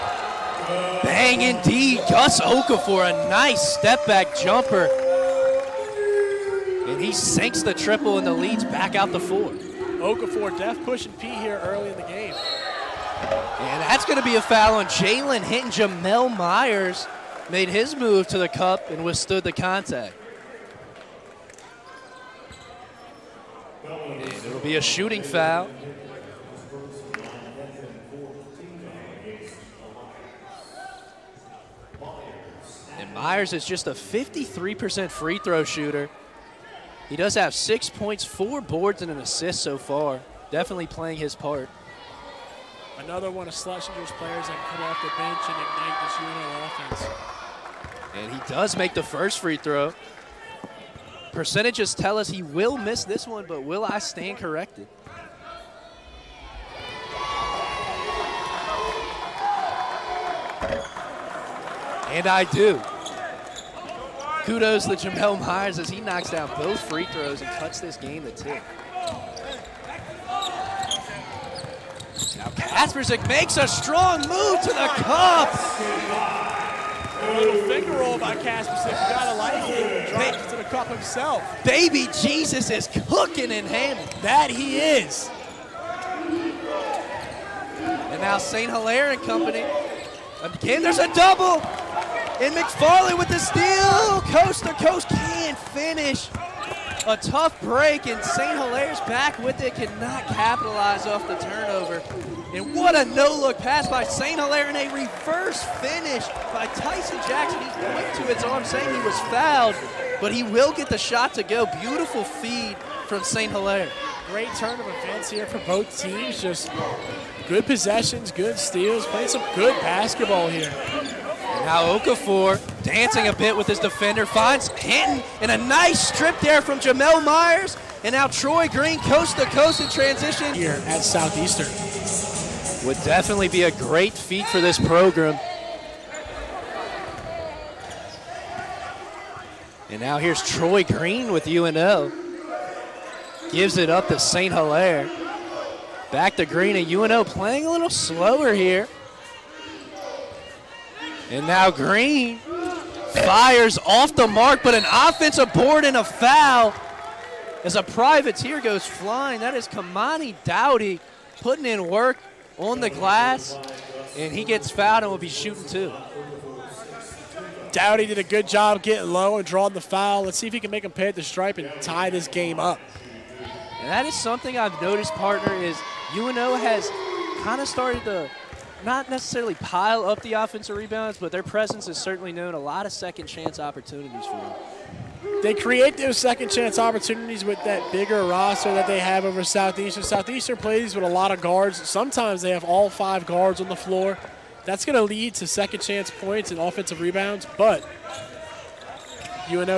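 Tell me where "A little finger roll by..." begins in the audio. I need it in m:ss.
1:17.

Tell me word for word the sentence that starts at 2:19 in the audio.
And now here's Troy Green with UNO.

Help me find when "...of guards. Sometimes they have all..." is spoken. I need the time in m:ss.
3:11.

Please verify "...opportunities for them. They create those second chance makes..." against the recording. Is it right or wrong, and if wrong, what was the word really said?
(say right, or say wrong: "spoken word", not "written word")
wrong: "opportunities", not "makes".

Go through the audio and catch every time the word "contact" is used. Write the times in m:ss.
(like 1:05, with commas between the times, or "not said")
0:19.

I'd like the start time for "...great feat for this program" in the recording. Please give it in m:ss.
2:13.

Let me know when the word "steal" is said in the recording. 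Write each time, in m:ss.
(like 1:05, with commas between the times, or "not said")
1:33, 1:58.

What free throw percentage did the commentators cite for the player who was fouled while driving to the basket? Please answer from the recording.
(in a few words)
53%.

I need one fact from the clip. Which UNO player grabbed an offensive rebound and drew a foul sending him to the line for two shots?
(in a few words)
Kamani Dowdy.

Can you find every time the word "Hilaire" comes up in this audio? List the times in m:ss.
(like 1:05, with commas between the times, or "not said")
1:28, 1:38, 1:44, 1:53, 2:24.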